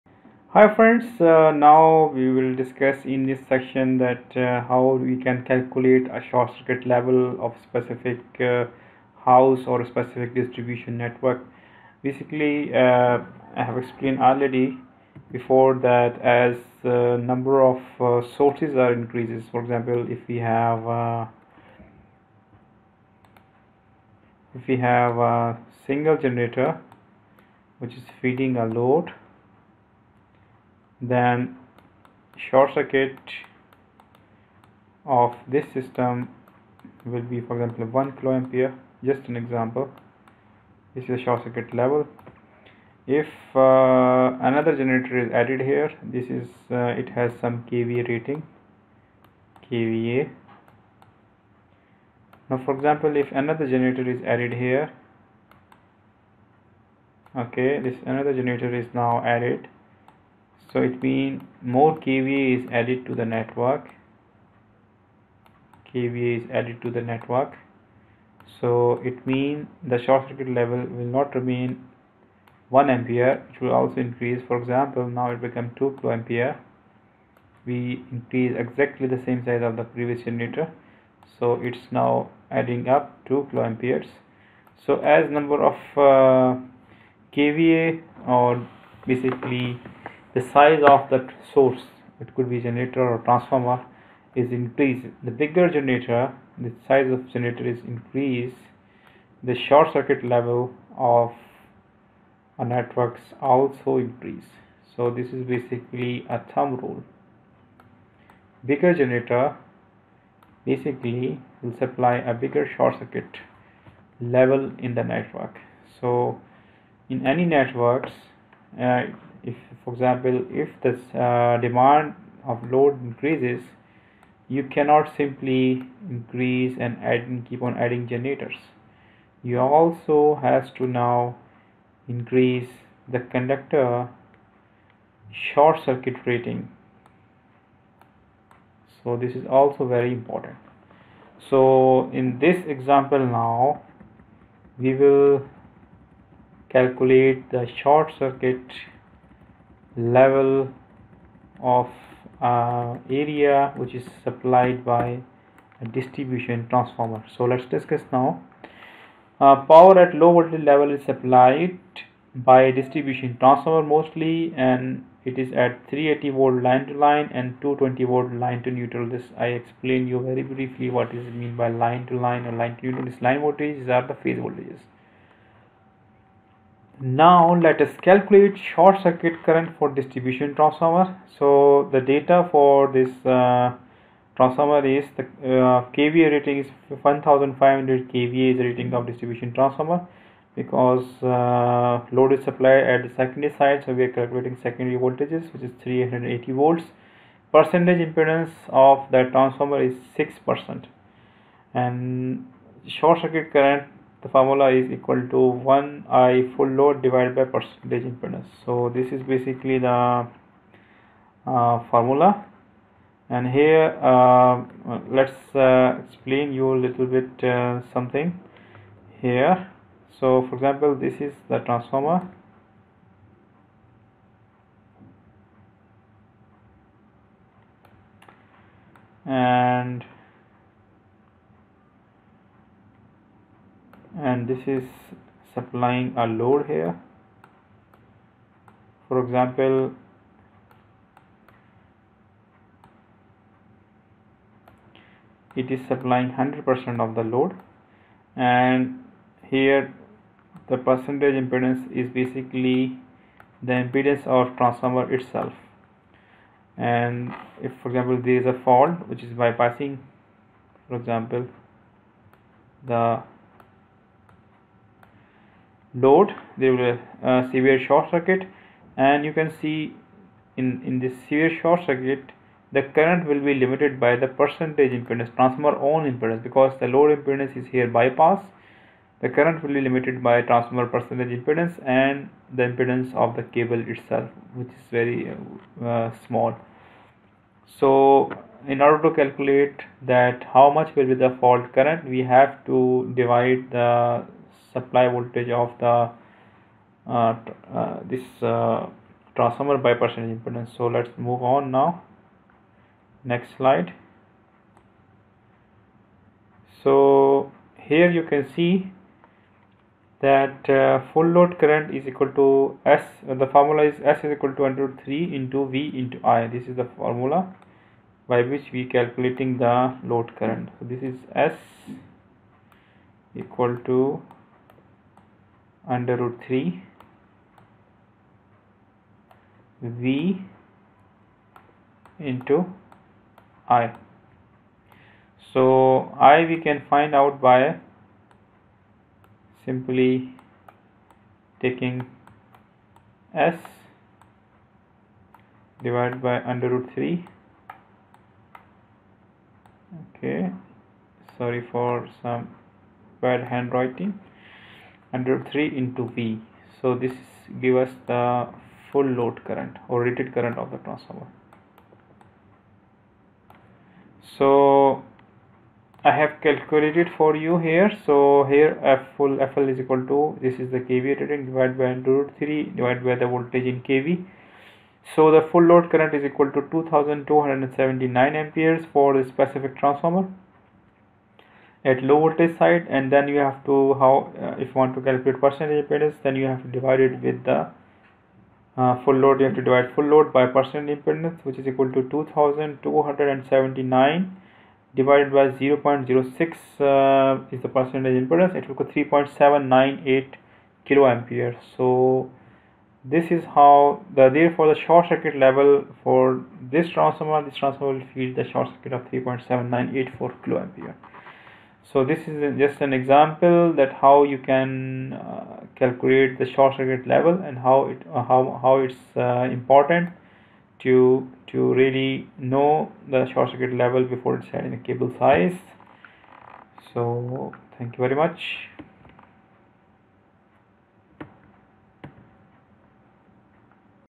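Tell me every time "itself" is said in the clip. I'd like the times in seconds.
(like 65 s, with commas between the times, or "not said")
255 s, 283 s.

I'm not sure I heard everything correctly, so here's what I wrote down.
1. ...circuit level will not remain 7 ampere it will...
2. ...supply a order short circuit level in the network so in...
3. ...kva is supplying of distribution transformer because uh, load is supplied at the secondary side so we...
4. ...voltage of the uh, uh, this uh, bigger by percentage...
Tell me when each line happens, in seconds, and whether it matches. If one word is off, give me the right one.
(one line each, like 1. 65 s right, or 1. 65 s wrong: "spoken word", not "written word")
1. 70 s wrong: "1", not "7"
2. 111 s wrong: "bigger", not "order"
3. 188 s wrong: "rating", not "supplying"
4. 295 s wrong: "transformer", not "bigger".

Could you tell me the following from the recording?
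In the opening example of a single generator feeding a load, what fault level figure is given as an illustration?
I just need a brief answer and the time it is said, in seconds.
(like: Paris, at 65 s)
1 kiloampere, at 38 s.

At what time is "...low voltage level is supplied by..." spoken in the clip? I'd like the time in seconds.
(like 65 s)
160 s.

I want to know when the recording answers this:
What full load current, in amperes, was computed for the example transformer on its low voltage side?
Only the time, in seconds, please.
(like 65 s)
376 s.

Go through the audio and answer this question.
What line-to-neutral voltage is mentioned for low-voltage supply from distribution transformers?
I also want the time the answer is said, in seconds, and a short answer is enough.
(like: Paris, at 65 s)
220 volts, at 167 s.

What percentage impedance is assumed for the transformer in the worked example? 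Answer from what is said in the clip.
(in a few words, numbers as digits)
6 percent.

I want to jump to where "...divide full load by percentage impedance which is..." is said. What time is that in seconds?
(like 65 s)
389 s.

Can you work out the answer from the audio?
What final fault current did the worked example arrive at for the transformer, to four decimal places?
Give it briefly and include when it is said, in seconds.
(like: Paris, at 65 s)
3.7984 kiloamperes, at 409 s.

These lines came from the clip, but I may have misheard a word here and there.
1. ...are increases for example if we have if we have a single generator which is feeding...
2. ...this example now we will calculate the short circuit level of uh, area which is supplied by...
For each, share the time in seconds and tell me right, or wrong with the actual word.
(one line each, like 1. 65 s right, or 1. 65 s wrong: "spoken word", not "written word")
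1. 18 s right
2. 142 s right.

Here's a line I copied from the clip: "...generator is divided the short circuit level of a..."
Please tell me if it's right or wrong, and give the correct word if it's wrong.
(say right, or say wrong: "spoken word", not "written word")
wrong: "increased", not "divided".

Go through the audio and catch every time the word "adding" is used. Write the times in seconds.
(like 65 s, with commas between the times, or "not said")
82 s, 127 s.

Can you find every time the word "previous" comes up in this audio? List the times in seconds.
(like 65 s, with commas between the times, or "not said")
79 s.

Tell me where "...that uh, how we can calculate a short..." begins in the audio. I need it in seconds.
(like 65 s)
3 s.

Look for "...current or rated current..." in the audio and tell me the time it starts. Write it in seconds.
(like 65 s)
359 s.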